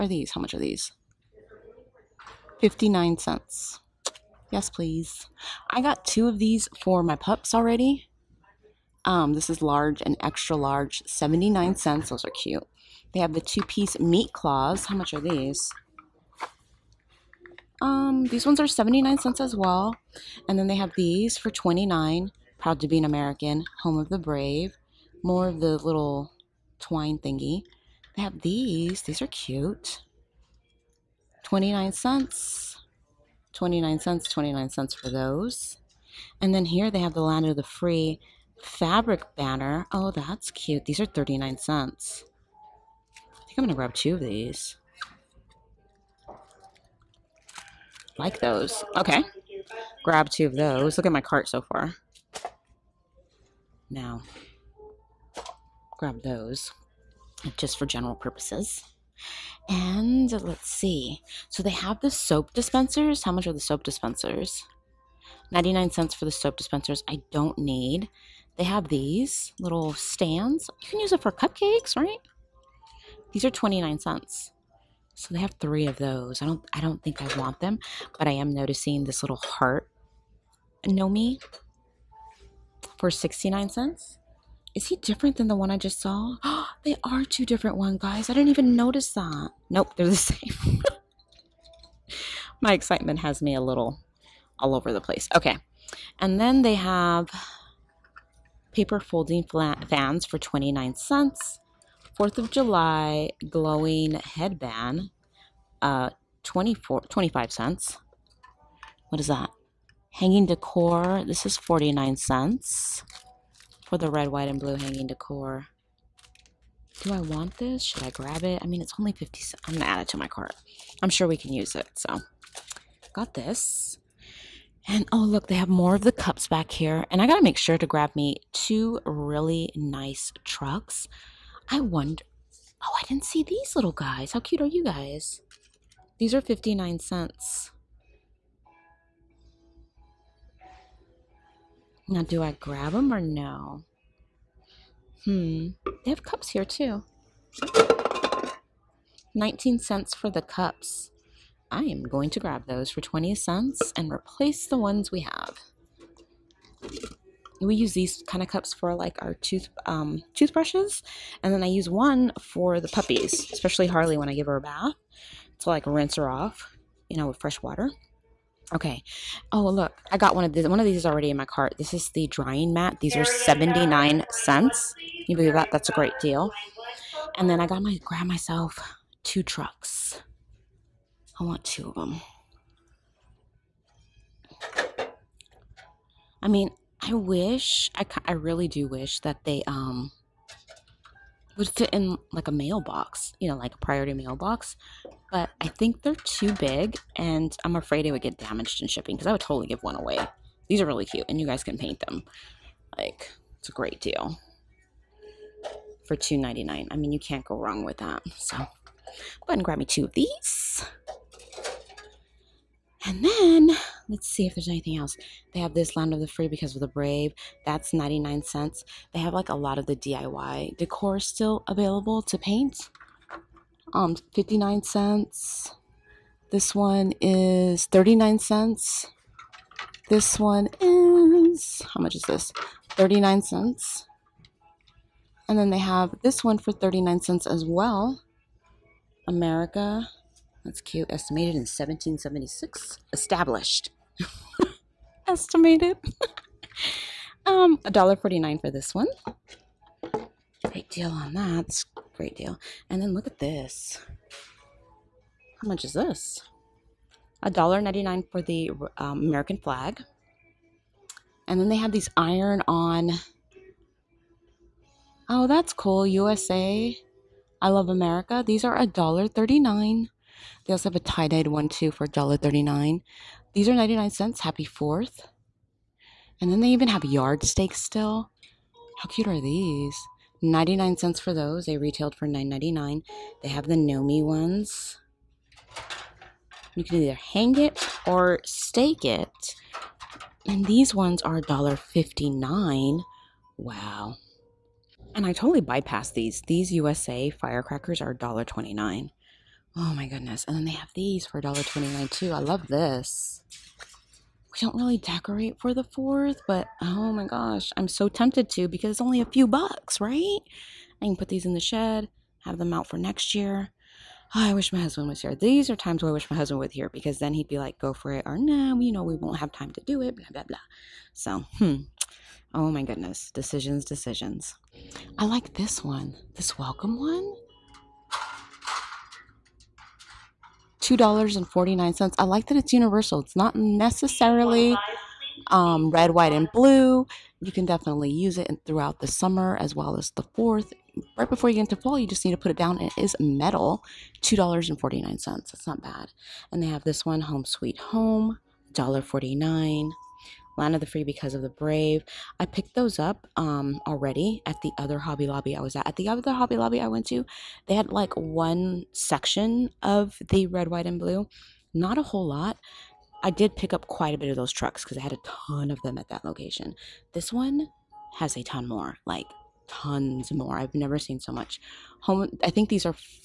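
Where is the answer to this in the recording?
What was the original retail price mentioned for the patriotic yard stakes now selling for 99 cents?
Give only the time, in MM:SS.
04:42.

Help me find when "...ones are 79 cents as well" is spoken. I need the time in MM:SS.
00:18.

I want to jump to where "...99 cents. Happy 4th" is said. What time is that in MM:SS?
04:33.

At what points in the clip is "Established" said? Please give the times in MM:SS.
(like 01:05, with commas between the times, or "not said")
04:03.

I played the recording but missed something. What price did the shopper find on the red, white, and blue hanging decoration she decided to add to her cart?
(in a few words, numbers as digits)
49 cents.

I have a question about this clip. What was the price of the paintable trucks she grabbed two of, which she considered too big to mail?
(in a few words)
$2.99.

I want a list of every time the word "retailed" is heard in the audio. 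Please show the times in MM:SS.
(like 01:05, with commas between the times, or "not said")
04:41.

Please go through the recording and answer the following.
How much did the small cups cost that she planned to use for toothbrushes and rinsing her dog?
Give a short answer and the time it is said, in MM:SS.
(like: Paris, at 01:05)
19 cents, at 02:29.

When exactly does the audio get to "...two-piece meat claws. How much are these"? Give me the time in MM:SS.
00:13.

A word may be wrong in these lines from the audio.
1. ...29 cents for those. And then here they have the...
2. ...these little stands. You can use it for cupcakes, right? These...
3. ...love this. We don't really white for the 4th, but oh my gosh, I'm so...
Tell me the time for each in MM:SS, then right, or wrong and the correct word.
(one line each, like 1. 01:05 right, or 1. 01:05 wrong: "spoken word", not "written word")
1. 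00:34 right
2. 01:08 right
3. 05:02 wrong: "decorate", not "white".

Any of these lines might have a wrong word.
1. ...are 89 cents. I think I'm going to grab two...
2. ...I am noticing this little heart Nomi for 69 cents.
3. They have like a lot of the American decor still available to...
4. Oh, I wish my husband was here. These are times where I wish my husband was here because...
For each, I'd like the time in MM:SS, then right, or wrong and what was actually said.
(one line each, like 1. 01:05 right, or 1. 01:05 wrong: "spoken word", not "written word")
1. 00:40 wrong: "39", not "89"
2. 01:18 right
3. 03:39 wrong: "DIY", not "American"
4. 05:14 right.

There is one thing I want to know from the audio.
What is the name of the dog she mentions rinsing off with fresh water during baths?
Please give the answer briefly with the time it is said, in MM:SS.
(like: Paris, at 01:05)
Harley, at 02:43.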